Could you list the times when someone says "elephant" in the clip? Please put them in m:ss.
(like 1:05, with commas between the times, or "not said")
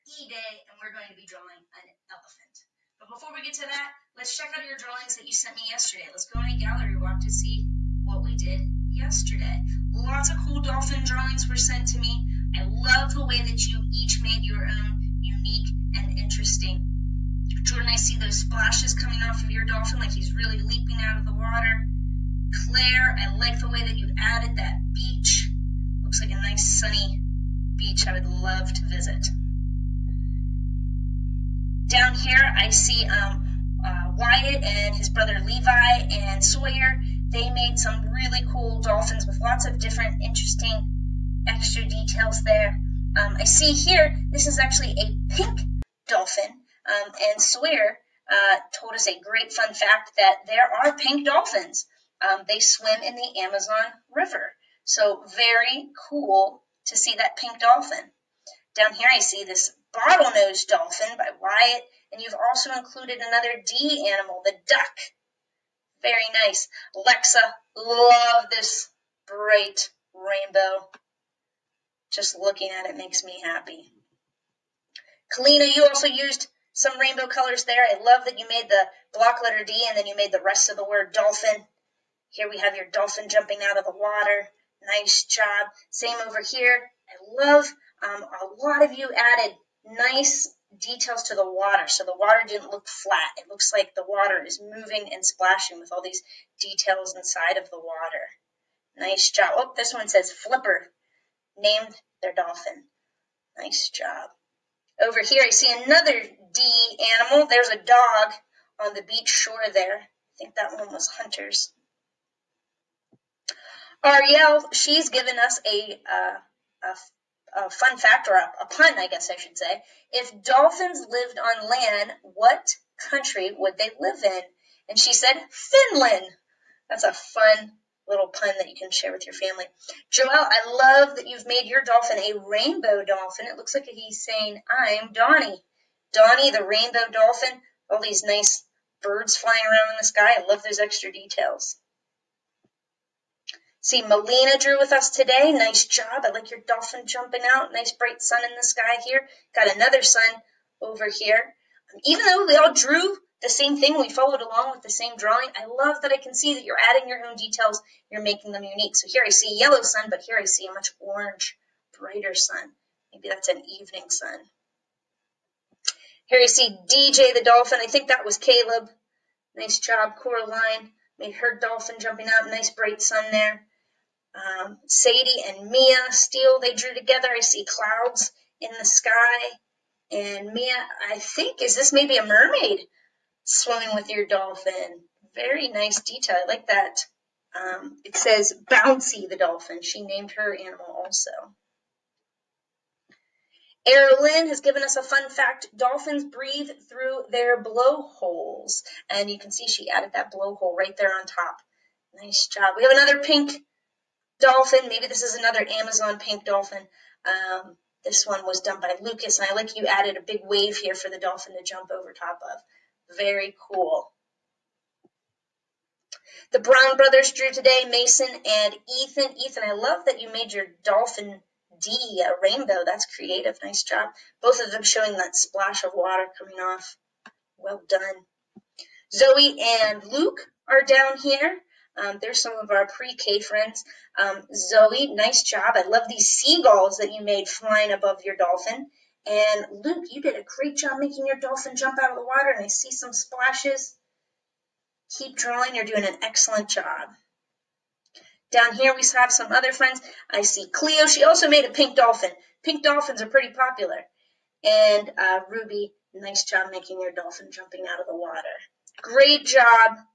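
0:02.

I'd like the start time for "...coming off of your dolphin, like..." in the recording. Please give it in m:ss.
0:18.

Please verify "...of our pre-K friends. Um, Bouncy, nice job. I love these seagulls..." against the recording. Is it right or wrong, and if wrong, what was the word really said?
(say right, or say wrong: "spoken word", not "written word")
wrong: "Zoe", not "Bouncy".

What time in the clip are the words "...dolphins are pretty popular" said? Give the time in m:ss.
4:12.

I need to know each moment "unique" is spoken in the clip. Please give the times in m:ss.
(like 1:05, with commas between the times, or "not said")
0:15, 2:38.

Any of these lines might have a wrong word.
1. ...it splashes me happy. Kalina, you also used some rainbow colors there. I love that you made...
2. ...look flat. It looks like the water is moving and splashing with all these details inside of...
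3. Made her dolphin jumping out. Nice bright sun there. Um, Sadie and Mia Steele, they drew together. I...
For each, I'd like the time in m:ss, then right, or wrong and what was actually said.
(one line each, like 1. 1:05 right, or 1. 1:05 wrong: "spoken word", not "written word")
1. 1:12 wrong: "makes", not "splashes"
2. 1:32 right
3. 2:51 right.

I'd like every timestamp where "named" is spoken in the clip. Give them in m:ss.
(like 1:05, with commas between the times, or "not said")
1:41, 3:10.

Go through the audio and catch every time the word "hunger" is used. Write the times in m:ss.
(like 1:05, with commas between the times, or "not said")
not said.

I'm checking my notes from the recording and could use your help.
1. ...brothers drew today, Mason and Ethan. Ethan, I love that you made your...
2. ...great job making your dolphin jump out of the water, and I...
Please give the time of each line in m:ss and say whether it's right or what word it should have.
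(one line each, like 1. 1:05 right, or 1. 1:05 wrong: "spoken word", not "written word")
1. 3:36 right
2. 4:00 right.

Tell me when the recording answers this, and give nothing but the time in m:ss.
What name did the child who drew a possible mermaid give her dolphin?
3:08.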